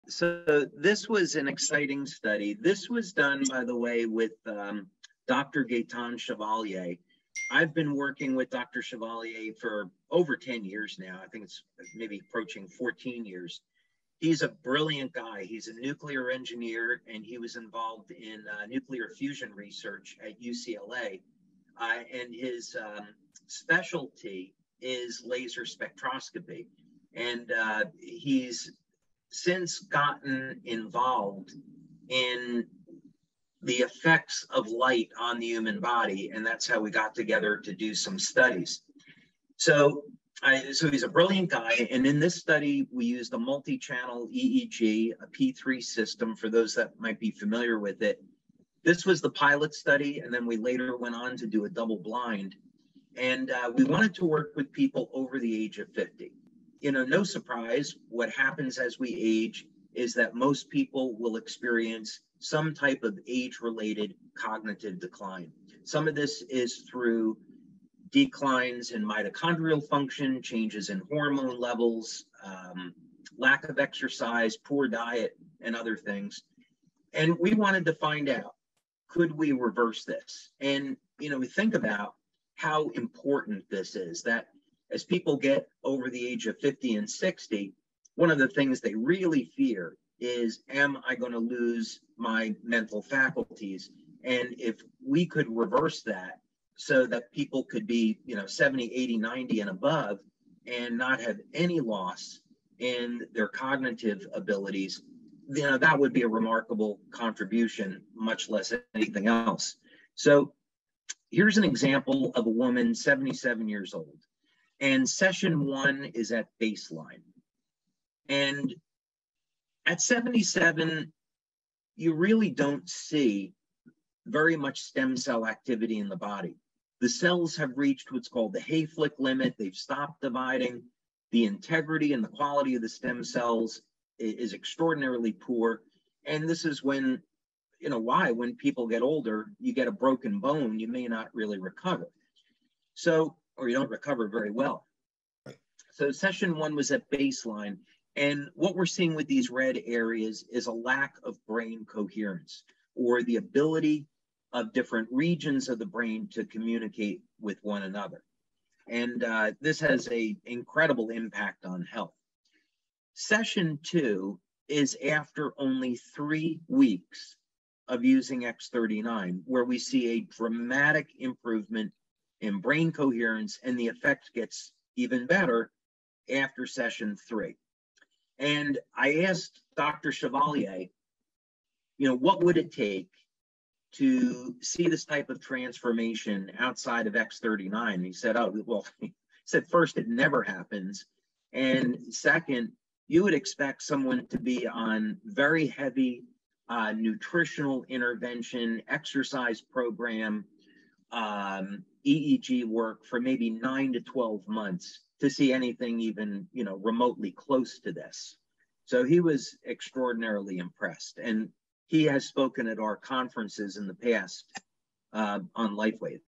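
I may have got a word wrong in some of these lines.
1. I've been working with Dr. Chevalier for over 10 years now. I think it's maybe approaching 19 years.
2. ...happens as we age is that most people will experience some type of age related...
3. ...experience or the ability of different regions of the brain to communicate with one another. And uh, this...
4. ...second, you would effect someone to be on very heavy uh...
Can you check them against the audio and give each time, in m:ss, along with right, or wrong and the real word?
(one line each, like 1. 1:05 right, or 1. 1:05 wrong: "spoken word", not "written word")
1. 0:07 wrong: "14", not "19"
2. 0:58 right
3. 2:31 wrong: "coherence", not "experience"
4. 3:12 wrong: "expect", not "effect".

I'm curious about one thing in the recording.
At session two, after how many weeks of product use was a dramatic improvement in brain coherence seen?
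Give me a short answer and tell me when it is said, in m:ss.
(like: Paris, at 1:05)
3, at 2:45.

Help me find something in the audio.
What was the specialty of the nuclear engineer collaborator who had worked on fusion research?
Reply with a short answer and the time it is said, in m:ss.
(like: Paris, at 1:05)
laser spectroscopy, at 0:25.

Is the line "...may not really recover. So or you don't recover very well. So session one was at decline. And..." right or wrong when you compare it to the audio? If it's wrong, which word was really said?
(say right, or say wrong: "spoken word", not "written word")
wrong: "baseline", not "decline".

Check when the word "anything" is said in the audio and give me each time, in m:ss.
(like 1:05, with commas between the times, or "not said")
1:48, 3:25.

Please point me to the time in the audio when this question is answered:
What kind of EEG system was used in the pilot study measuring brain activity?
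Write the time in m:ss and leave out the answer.
0:45.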